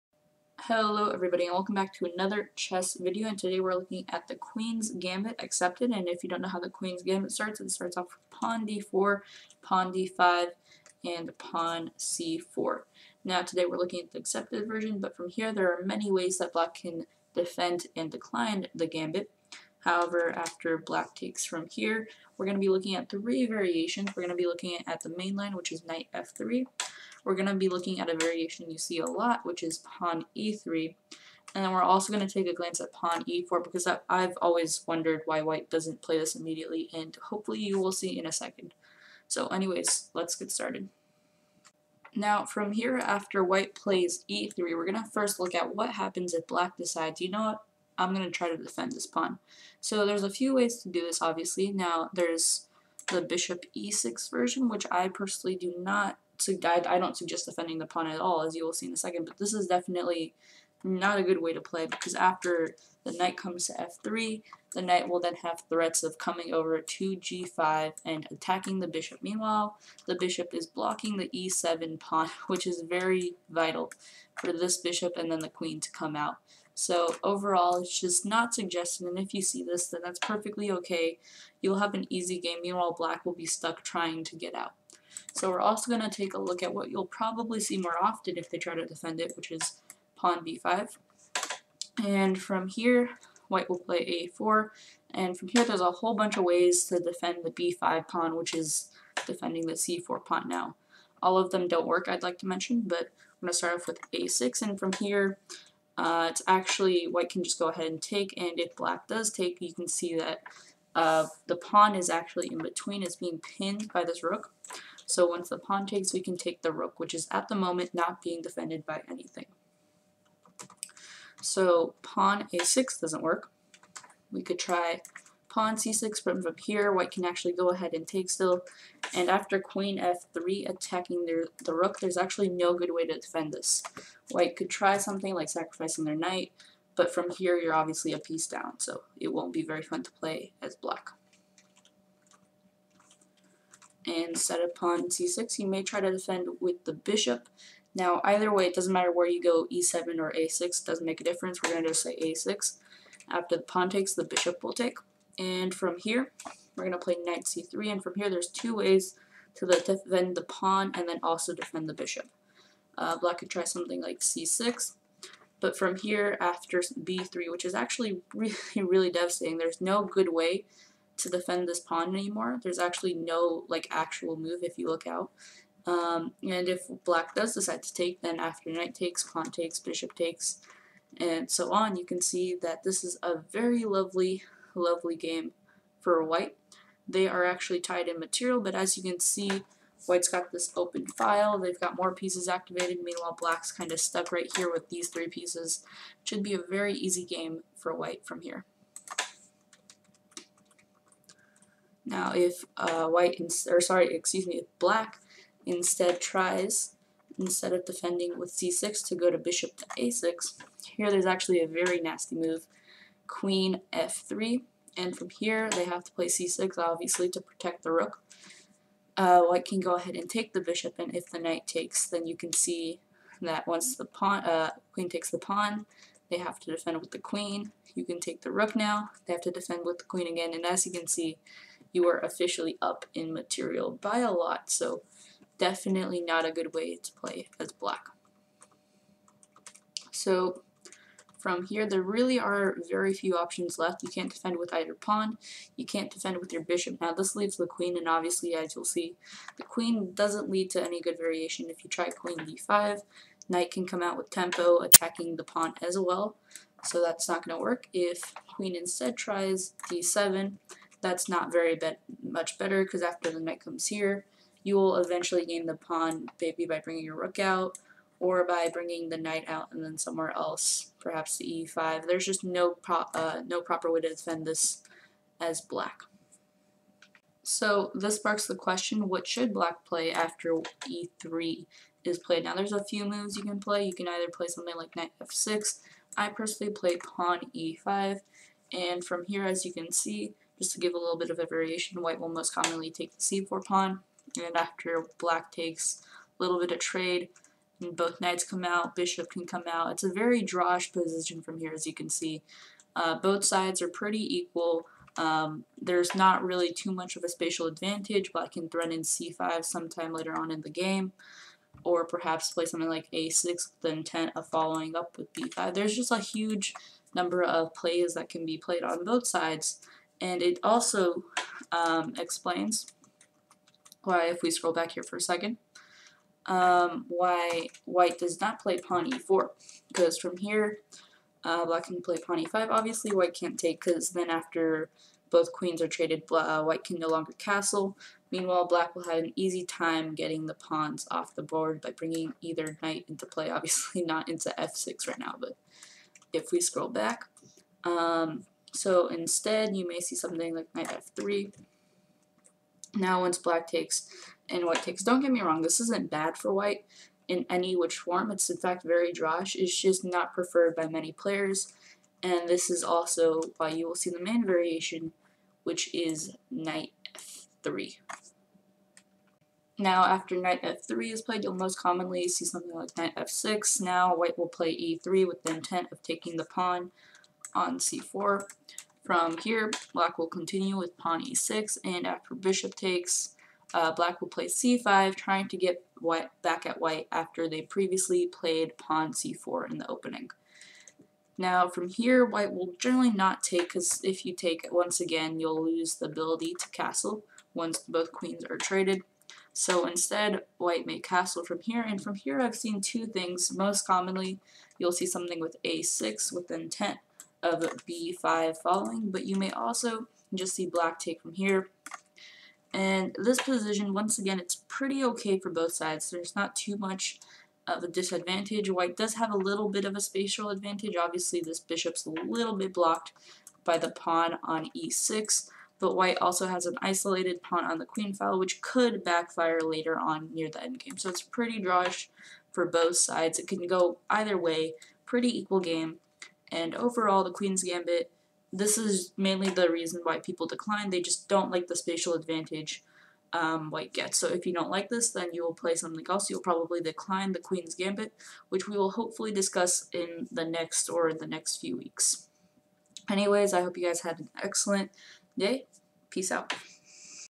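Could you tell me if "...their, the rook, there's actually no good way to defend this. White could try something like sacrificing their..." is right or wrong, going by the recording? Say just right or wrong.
right.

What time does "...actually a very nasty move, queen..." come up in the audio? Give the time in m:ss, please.
3:31.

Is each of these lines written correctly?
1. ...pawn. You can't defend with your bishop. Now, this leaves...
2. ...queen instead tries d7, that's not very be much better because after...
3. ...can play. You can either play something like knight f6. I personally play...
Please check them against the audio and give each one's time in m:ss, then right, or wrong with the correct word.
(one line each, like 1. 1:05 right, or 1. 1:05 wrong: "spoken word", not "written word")
1. 4:04 right
2. 4:18 right
3. 4:43 right.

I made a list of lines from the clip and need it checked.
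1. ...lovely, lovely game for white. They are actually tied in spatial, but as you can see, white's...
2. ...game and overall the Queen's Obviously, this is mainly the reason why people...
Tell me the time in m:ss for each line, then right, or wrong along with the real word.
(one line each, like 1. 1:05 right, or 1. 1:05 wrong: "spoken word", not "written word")
1. 3:03 wrong: "material", not "spatial"
2. 7:15 wrong: "Gambit", not "Obviously".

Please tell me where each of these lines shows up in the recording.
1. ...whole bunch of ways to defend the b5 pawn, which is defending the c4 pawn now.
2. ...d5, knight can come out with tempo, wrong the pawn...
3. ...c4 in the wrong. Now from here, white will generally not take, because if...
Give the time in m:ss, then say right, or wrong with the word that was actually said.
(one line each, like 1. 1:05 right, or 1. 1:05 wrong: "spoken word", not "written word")
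1. 1:35 right
2. 4:12 wrong: "attacking", not "wrong"
3. 6:29 wrong: "opening", not "wrong".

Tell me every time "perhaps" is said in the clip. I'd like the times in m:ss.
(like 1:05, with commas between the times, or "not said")
4:30, 5:12.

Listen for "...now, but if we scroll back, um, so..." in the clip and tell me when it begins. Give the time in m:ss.
5:45.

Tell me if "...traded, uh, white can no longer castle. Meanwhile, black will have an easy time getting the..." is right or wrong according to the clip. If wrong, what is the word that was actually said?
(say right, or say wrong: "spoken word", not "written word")
right.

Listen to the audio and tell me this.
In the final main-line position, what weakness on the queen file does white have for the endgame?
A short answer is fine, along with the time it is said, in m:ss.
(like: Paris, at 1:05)
an isolated pawn, at 7:06.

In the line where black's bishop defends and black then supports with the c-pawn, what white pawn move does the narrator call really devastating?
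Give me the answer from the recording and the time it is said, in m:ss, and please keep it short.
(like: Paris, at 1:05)
b3, at 2:46.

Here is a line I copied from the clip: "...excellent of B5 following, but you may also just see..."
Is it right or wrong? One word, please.
wrong.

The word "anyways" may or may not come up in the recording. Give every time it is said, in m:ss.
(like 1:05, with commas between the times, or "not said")
0:39, 7:33.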